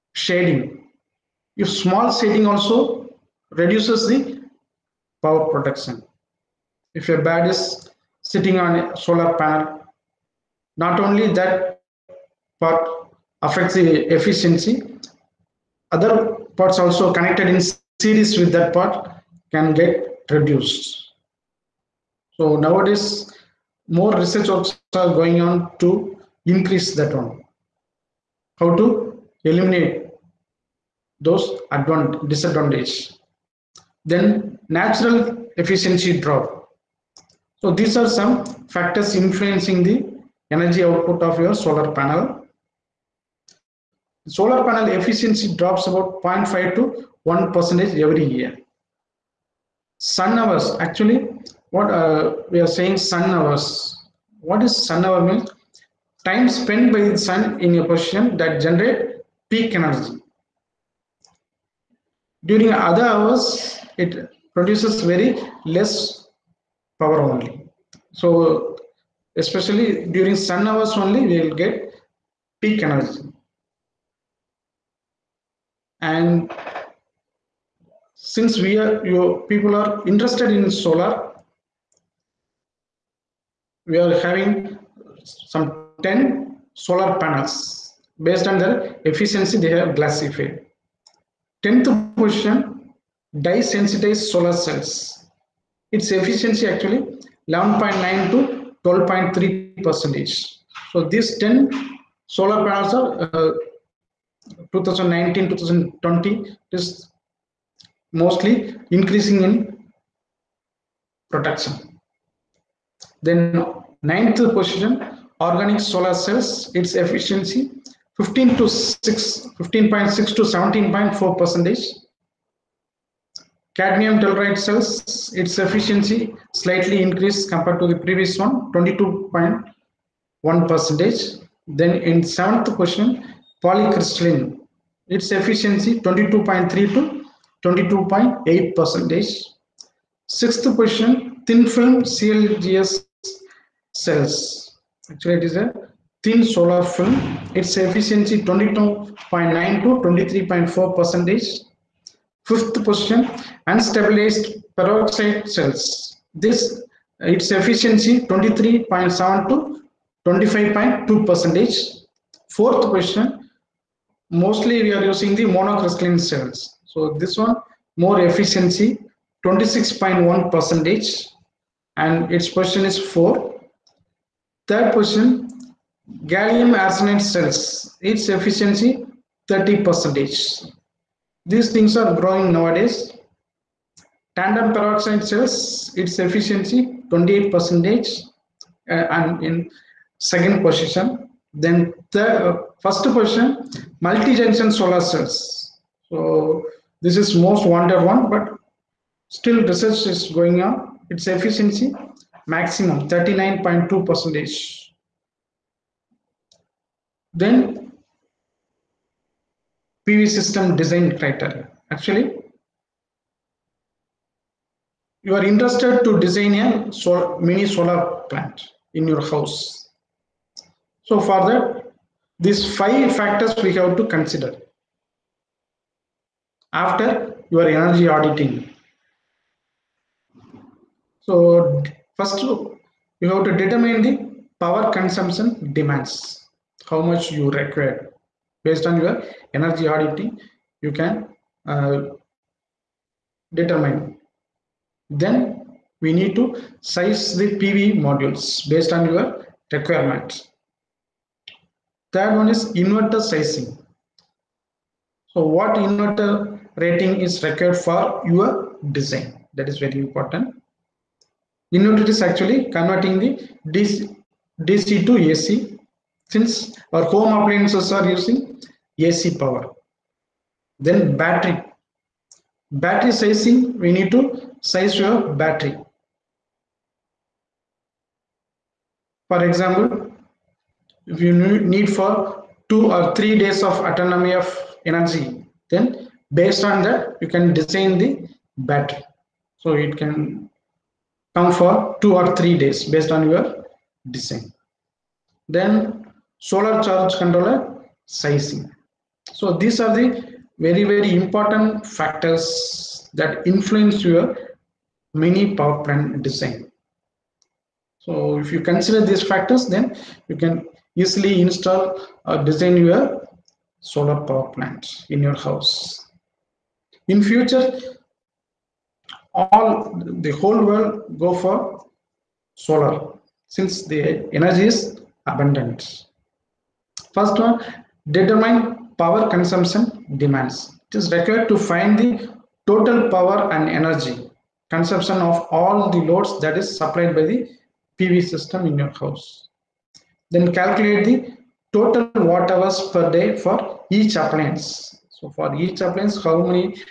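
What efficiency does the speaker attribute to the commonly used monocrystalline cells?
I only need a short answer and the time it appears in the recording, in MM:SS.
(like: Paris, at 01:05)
26.1 percent, at 02:49.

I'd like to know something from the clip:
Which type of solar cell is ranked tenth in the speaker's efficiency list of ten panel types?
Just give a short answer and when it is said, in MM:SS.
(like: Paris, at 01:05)
Dye sensitized solar cells, at 01:33.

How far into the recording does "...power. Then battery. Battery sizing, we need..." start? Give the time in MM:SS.
04:29.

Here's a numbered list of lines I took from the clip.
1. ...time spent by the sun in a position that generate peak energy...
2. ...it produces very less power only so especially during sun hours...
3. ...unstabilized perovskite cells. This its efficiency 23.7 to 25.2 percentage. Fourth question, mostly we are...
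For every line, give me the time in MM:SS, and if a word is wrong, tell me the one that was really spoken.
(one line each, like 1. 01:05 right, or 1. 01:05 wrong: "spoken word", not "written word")
1. 00:56 right
2. 01:04 right
3. 02:33 right.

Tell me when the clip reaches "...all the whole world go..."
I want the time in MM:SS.
05:19.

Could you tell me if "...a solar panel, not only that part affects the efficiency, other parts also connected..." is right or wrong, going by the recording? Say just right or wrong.
right.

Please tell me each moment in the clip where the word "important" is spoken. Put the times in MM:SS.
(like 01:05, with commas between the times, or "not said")
04:19, 05:01.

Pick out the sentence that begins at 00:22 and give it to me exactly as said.
So nowadays, more research also are going on to increase that one.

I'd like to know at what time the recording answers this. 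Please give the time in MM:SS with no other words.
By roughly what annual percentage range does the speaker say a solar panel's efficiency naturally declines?
00:46.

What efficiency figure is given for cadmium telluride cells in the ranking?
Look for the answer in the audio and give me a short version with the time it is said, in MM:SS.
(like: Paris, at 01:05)
22.1 percent, at 02:08.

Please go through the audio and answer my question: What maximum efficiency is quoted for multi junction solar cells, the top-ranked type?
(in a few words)
39.2 percent.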